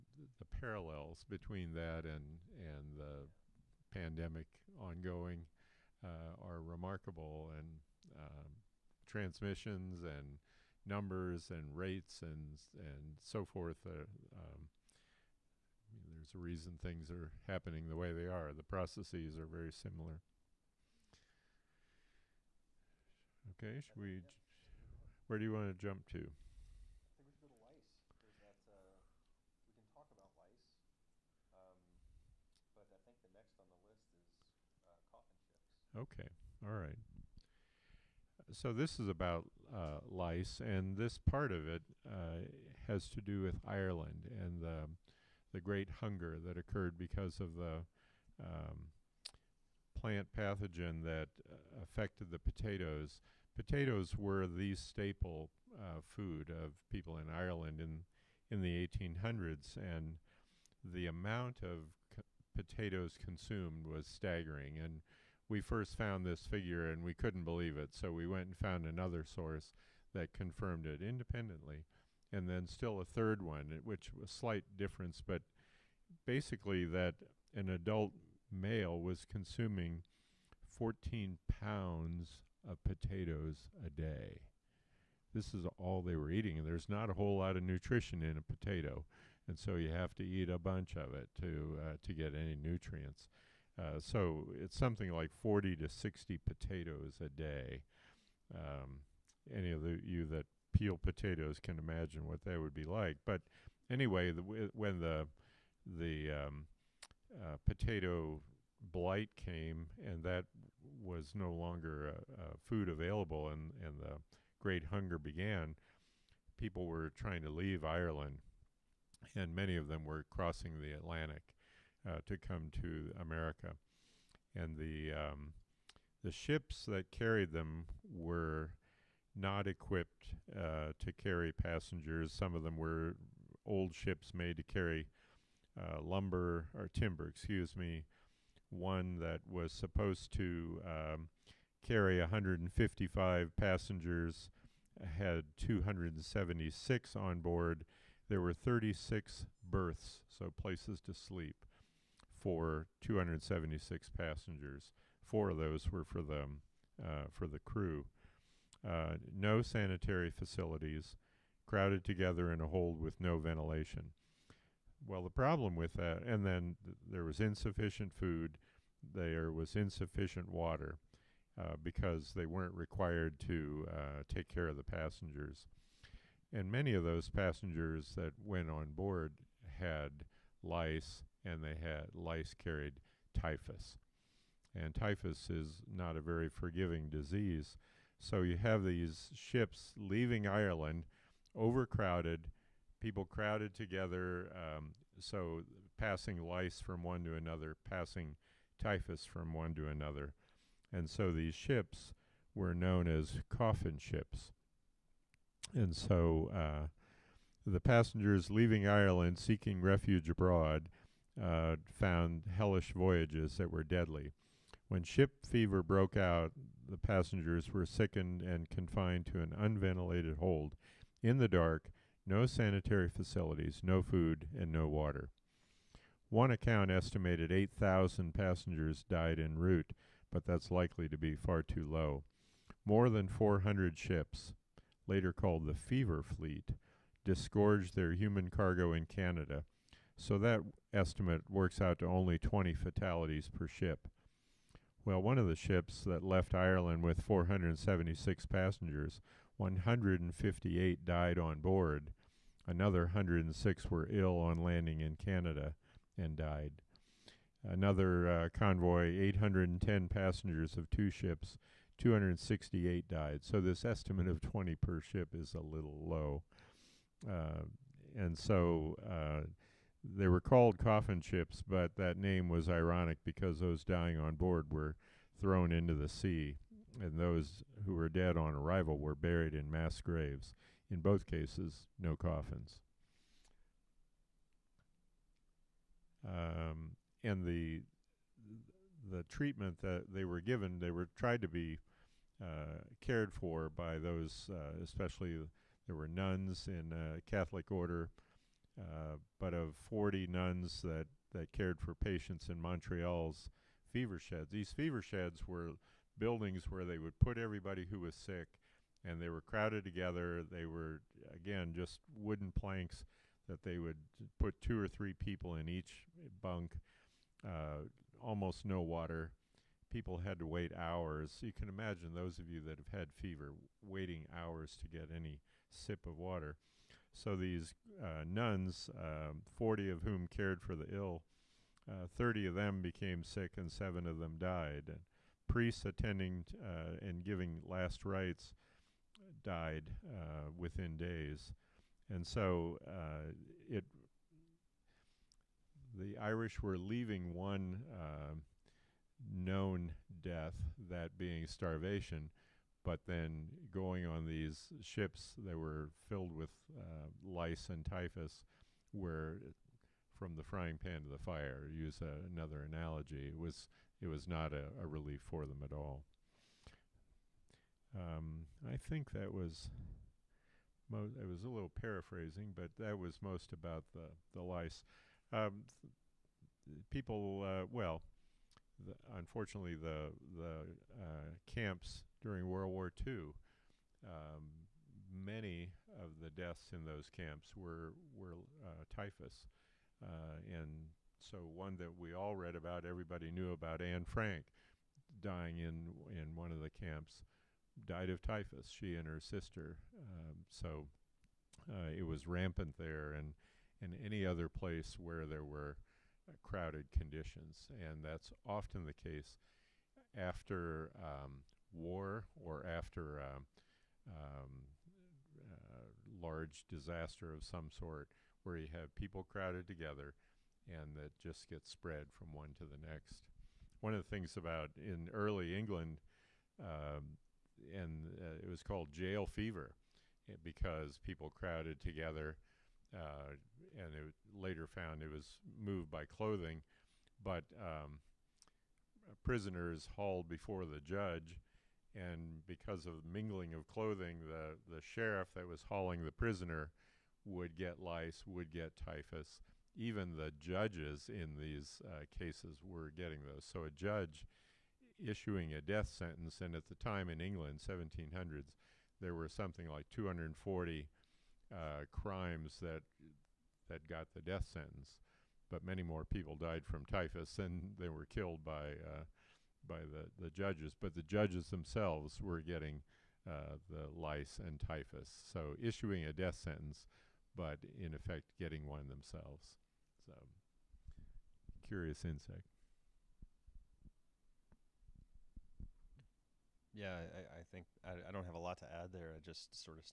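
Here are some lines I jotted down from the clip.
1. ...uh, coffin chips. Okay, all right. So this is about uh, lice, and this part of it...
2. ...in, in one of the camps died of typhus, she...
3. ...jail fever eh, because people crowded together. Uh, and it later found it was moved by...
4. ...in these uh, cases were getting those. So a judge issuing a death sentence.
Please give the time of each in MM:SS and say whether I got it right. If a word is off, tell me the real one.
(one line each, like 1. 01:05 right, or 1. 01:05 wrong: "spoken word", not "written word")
1. 00:34 right
2. 06:35 right
3. 07:08 right
4. 07:31 right.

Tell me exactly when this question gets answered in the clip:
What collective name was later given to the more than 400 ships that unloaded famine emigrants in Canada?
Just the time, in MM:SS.
03:55.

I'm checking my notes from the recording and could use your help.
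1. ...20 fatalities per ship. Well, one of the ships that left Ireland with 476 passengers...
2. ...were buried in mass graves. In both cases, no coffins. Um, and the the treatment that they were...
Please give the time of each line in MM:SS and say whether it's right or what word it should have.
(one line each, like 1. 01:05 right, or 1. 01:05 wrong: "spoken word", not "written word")
1. 04:02 right
2. 04:38 right.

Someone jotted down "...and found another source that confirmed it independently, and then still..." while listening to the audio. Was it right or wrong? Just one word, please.
right.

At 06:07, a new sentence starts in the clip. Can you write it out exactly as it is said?
Um, I think that was, mo- it was a little paraphrasing, but that was most about the, the lice.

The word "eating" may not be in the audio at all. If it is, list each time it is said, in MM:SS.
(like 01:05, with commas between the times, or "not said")
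01:26.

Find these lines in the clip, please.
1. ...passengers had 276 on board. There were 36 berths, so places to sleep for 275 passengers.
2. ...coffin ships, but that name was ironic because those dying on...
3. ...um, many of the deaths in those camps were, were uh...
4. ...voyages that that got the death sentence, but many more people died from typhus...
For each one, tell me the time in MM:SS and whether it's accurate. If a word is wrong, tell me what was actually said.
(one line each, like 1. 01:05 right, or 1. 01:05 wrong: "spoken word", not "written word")
1. 02:23 wrong: "276", not "275"
2. 04:30 right
3. 06:24 right
4. 07:41 wrong: "crimes", not "voyages".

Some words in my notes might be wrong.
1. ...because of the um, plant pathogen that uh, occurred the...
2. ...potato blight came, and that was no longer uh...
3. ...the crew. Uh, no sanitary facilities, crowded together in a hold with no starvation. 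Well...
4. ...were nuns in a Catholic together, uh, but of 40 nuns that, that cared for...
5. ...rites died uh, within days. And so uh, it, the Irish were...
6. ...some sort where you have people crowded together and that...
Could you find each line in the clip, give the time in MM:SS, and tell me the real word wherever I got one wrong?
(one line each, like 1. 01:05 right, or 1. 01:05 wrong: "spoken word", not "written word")
1. 00:46 wrong: "affected", not "occurred"
2. 01:47 right
3. 02:37 wrong: "ventilation", not "starvation"
4. 04:55 wrong: "order", not "together"
5. 05:38 right
6. 06:57 right.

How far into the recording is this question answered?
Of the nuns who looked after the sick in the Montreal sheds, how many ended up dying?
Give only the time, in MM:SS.
05:33.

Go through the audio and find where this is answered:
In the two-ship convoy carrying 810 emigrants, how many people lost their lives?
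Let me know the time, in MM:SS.
04:21.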